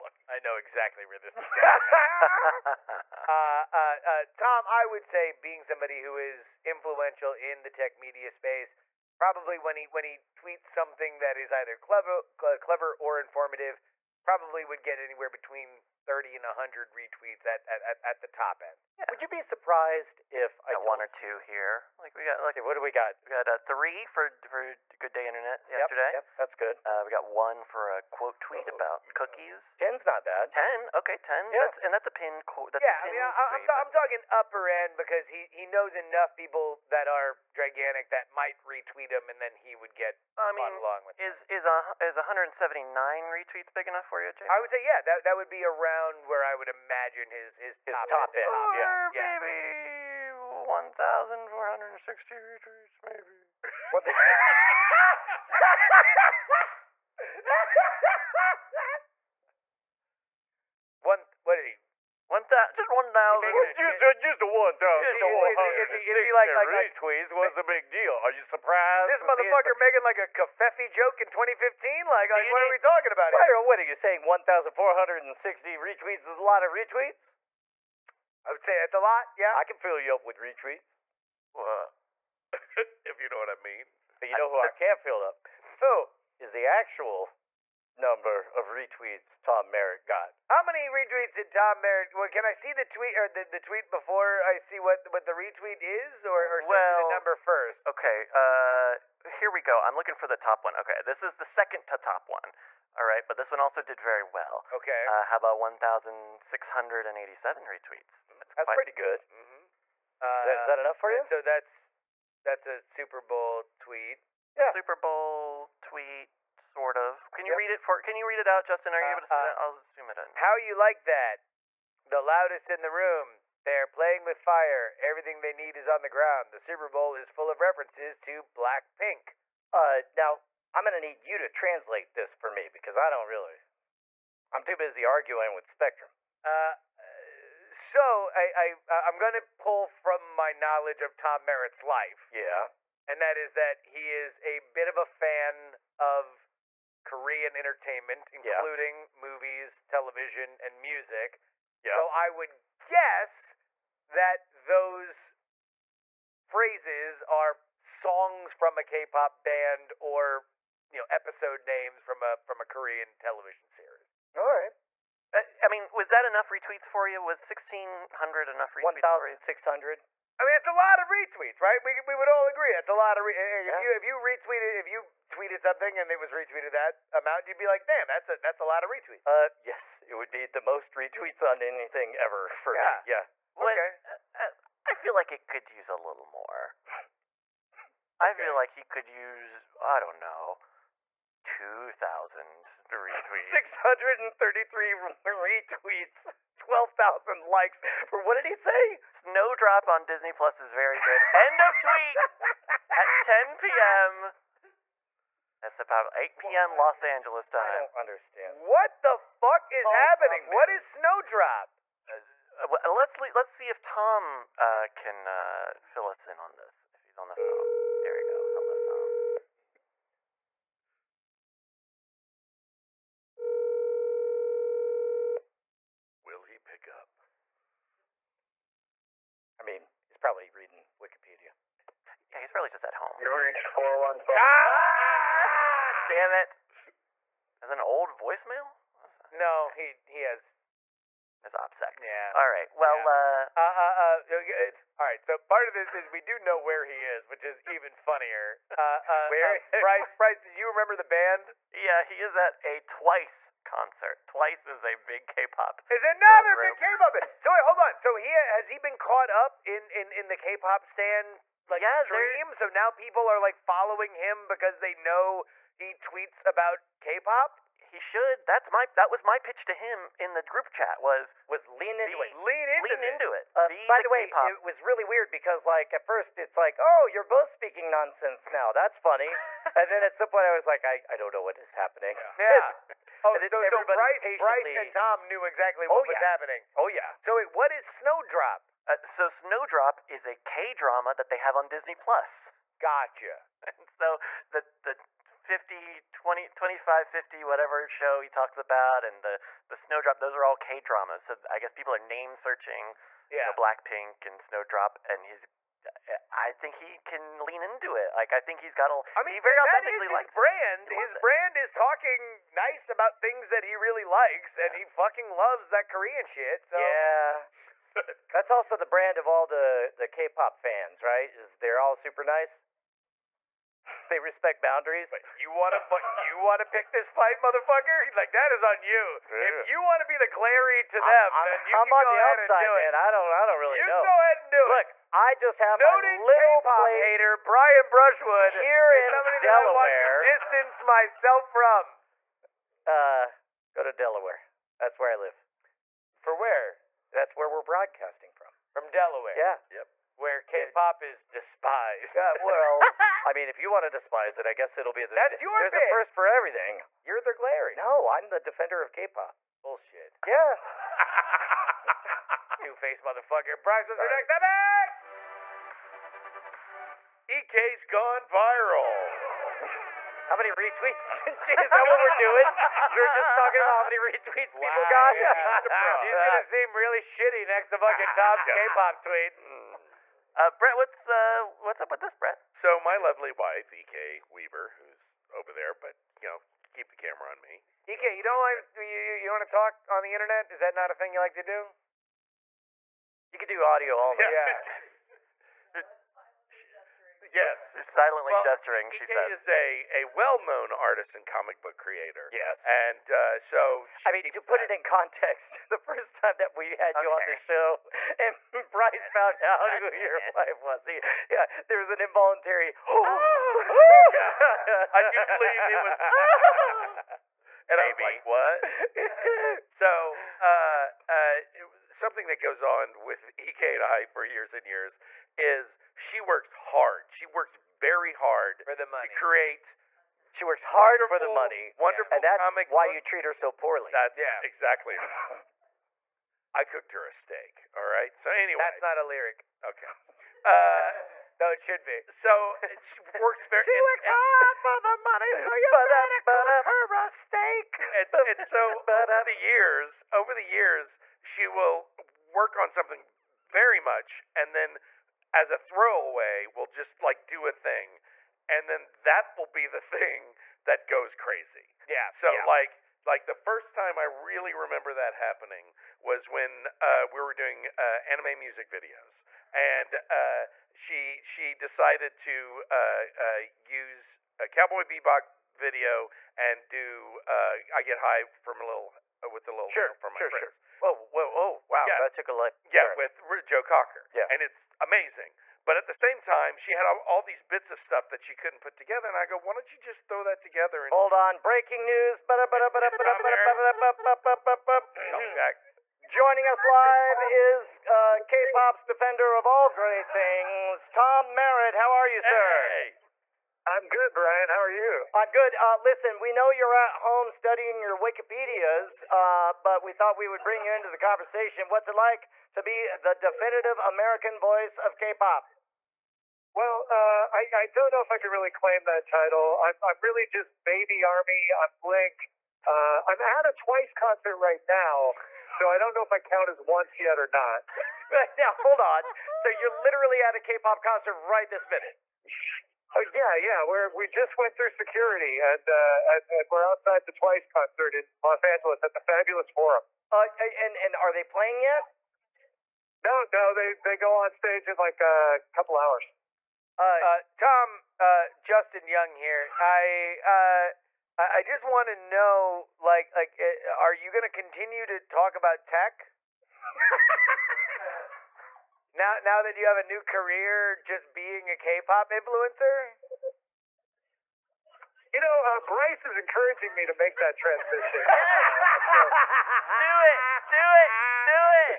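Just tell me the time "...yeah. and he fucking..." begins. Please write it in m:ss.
5:14.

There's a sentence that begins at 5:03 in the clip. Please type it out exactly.
you know blackpink and snowdrop and he's I think he can lean into it.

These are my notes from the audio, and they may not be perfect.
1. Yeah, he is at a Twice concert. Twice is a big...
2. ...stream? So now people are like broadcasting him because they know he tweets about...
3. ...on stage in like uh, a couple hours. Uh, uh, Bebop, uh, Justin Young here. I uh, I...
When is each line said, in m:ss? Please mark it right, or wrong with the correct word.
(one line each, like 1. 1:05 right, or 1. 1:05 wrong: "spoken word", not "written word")
1. 4:11 right
2. 4:22 wrong: "following", not "broadcasting"
3. 9:04 wrong: "Tom", not "Bebop".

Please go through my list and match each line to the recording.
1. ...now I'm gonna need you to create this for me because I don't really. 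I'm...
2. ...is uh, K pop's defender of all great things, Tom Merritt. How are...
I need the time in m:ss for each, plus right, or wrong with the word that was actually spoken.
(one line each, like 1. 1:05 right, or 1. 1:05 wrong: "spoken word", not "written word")
1. 2:10 wrong: "translate", not "create"
2. 8:17 right.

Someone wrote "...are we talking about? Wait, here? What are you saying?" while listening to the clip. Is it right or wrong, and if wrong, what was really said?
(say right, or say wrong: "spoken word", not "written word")
right.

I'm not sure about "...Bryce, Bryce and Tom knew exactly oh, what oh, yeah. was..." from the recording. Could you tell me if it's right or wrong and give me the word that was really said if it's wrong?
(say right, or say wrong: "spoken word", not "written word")
right.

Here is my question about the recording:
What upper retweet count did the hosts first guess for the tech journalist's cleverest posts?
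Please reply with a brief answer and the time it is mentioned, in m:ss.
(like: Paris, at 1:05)
100, at 0:16.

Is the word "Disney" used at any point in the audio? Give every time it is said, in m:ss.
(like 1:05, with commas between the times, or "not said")
3:20, 4:51.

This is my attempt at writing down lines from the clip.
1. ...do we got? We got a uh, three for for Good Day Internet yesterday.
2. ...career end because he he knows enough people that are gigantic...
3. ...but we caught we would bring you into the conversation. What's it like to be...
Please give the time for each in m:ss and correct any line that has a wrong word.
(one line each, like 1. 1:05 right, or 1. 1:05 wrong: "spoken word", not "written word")
1. 0:22 right
2. 0:34 wrong: "upper", not "career"
3. 8:29 wrong: "thought", not "caught".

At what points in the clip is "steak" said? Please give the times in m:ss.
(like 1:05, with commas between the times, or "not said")
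7:17, 7:27.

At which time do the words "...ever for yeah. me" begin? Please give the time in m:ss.
3:02.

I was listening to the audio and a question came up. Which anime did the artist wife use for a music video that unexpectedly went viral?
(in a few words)
Cowboy Bebop.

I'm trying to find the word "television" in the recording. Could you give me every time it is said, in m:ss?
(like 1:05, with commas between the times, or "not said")
2:29, 2:43.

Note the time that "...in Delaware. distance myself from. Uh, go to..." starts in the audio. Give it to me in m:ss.
5:38.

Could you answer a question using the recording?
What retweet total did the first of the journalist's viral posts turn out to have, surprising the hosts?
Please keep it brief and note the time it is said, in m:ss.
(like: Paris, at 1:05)
1,460, at 0:50.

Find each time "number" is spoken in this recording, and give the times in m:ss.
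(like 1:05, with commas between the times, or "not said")
1:27, 1:37.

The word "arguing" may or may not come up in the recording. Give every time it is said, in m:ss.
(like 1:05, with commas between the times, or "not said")
2:15.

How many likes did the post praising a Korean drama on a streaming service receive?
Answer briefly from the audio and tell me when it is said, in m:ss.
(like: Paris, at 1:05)
12,000, at 3:16.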